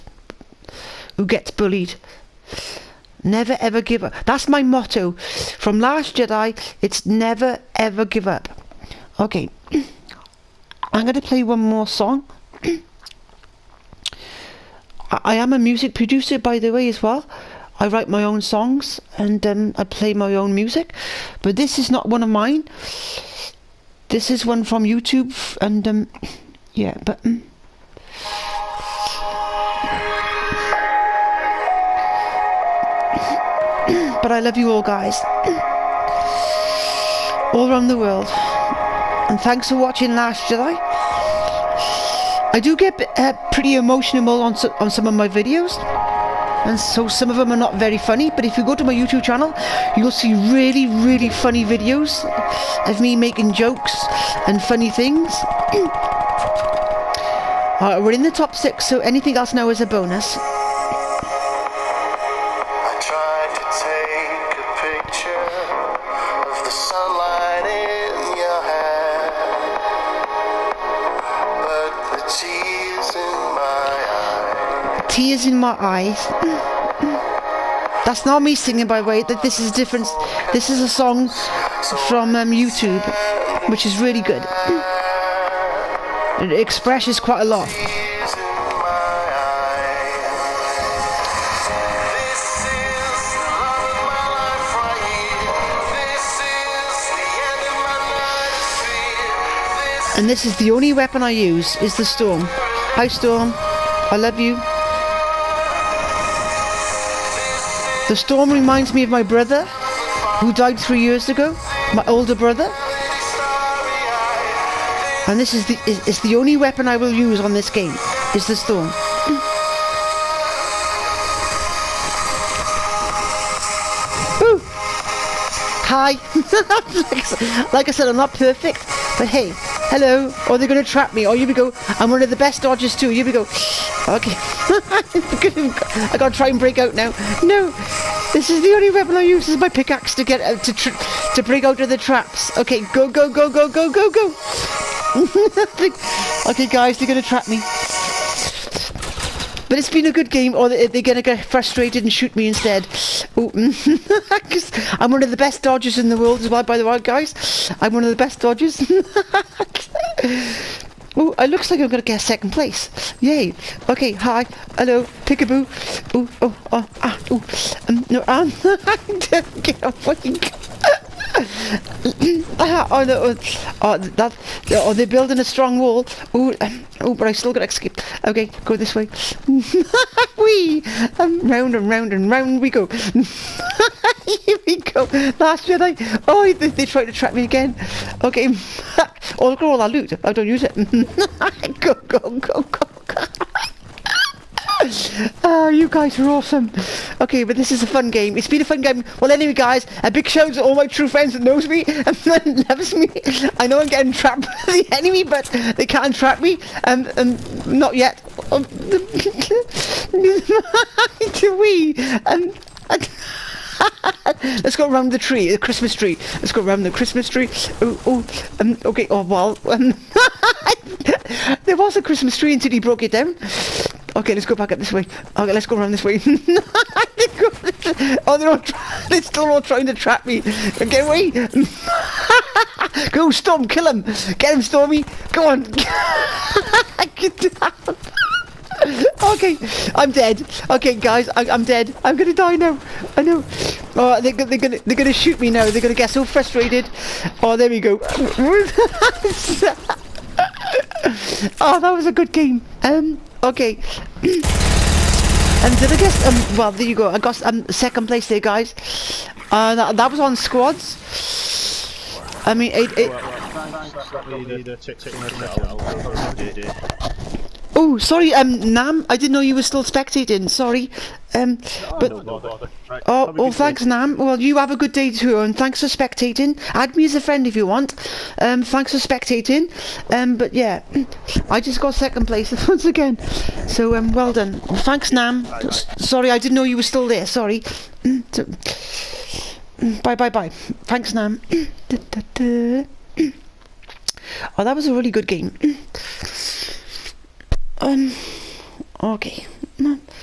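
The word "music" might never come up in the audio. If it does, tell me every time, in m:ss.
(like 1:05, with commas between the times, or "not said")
0:15, 0:20.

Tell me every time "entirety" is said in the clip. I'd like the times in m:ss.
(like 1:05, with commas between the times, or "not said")
not said.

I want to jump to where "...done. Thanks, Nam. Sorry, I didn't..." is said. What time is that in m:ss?
4:44.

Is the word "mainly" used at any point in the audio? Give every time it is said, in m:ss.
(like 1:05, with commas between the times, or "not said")
not said.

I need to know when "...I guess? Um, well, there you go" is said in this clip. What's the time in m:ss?
4:15.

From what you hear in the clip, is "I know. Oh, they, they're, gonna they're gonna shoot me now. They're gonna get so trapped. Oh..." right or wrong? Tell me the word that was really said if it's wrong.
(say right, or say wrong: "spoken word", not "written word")
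wrong: "frustrated", not "trapped".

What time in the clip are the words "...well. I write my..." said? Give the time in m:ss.
0:17.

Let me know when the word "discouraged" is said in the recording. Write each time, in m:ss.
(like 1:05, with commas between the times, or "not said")
not said.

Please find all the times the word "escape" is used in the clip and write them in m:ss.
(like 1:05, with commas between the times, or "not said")
2:57.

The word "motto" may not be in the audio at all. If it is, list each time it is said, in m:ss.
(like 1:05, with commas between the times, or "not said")
0:04.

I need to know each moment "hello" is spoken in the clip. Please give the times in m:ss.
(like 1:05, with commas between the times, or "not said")
2:09, 2:44.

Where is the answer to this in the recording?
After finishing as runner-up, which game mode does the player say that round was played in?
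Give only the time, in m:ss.
4:20.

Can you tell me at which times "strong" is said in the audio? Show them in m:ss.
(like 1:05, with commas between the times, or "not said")
2:55.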